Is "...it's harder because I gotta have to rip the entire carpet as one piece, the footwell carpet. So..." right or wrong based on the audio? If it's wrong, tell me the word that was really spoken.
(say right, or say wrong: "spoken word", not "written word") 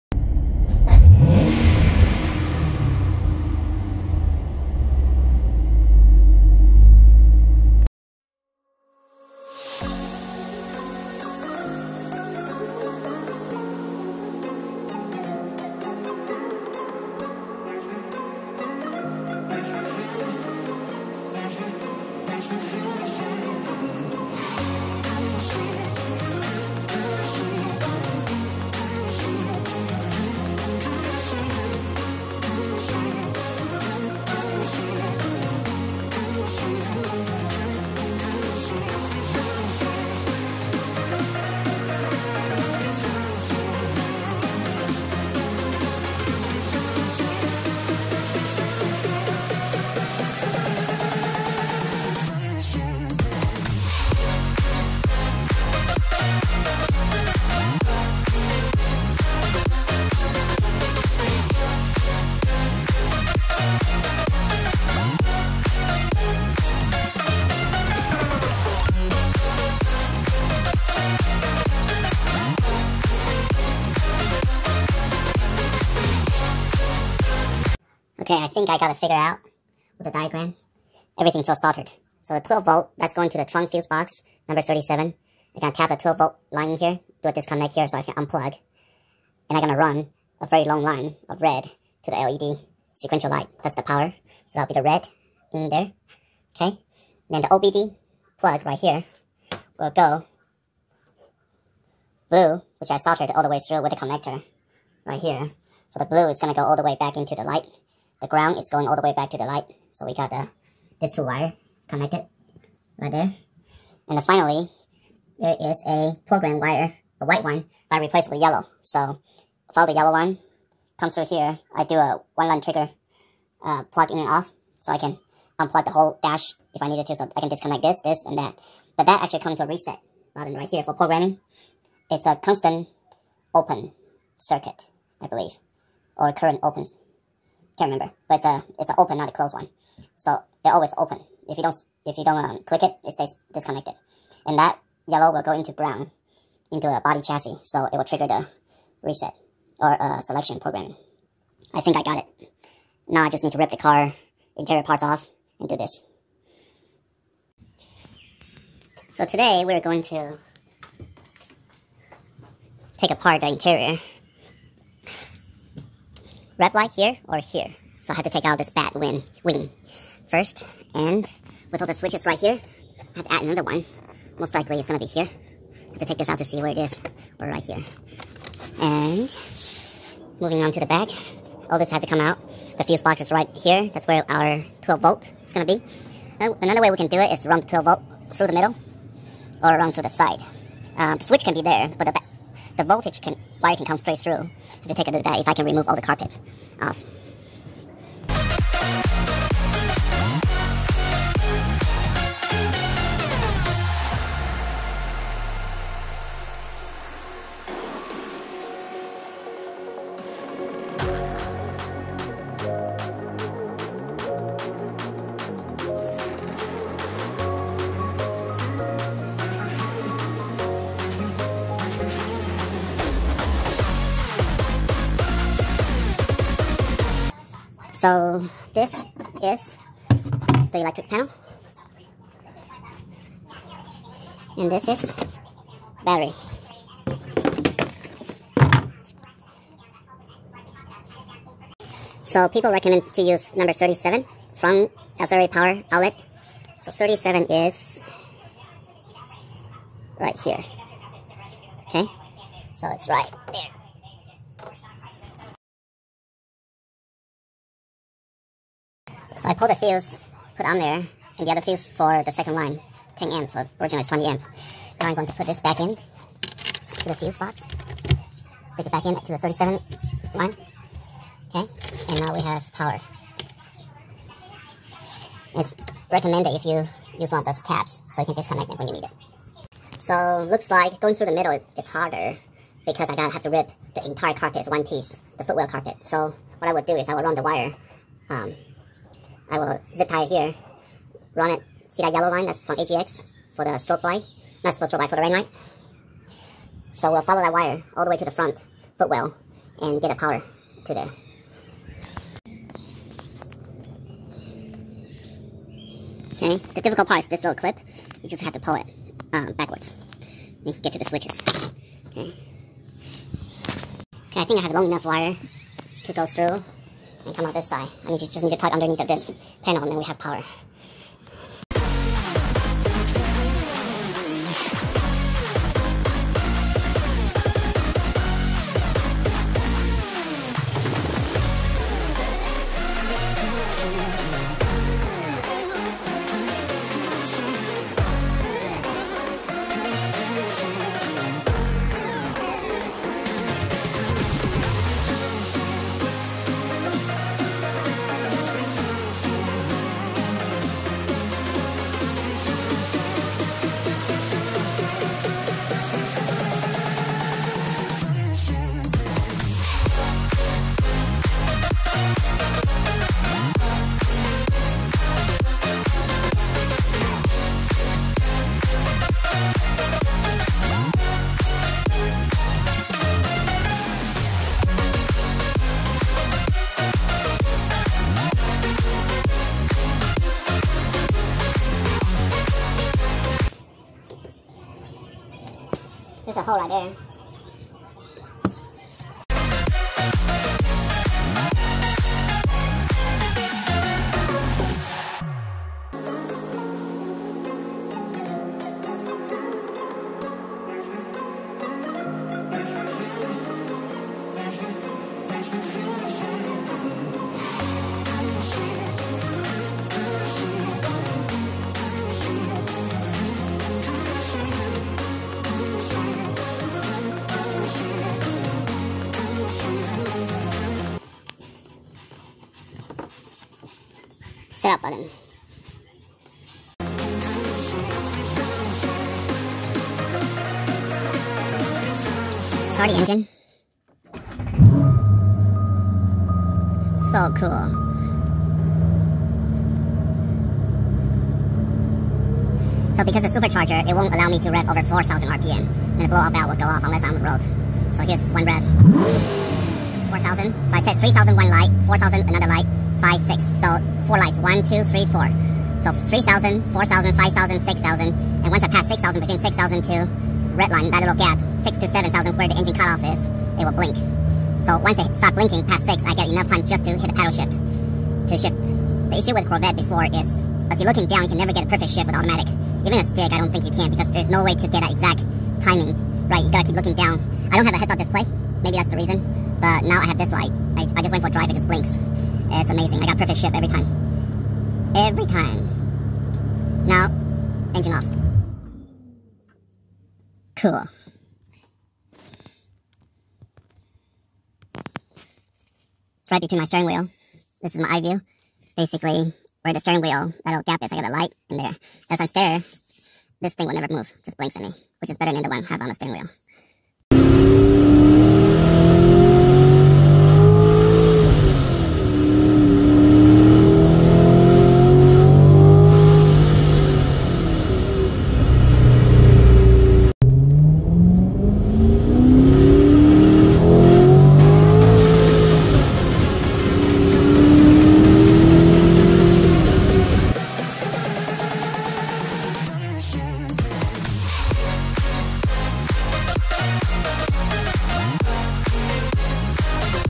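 right.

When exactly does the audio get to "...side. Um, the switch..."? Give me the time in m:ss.
3:10.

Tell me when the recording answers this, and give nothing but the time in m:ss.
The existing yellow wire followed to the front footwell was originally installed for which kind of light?
4:55.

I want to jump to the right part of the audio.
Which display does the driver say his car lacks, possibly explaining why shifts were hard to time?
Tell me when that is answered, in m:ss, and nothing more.
7:57.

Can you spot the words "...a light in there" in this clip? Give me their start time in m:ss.
8:21.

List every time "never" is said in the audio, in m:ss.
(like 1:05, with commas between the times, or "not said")
7:51, 8:23.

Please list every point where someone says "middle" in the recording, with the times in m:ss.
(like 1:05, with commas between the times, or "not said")
3:08, 4:41.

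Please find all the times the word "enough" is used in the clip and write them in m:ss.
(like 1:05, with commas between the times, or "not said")
5:14, 7:46.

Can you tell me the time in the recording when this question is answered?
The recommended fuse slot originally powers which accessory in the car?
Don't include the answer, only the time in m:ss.
4:05.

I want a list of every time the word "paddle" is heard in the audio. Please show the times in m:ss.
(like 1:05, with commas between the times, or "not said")
7:47.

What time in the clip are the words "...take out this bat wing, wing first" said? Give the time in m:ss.
2:48.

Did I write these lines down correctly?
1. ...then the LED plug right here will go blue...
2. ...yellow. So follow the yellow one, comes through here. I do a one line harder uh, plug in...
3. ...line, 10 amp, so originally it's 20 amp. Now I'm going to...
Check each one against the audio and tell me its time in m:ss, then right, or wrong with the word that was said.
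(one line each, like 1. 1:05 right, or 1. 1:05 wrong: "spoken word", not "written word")
1. 1:37 wrong: "OBD", not "LED"
2. 1:58 wrong: "trigger", not "harder"
3. 4:22 right.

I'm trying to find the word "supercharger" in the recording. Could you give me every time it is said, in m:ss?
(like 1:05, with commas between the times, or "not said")
7:23.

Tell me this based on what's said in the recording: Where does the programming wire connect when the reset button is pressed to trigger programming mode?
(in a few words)
body chassis.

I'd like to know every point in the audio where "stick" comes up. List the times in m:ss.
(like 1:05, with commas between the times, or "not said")
4:28, 7:53.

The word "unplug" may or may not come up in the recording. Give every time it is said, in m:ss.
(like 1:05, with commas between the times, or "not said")
1:28, 2:05.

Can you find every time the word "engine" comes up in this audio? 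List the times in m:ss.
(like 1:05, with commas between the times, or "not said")
7:12, 7:42, 8:07.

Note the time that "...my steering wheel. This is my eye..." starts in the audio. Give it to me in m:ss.
8:16.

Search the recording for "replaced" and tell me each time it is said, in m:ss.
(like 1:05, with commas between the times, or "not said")
1:57.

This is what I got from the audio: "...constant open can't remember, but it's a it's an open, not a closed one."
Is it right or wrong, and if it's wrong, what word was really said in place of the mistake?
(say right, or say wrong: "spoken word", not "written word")
wrong: "current", not "constant".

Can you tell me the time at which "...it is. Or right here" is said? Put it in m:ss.
2:56.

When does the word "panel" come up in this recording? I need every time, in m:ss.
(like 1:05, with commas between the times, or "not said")
3:51, 5:19.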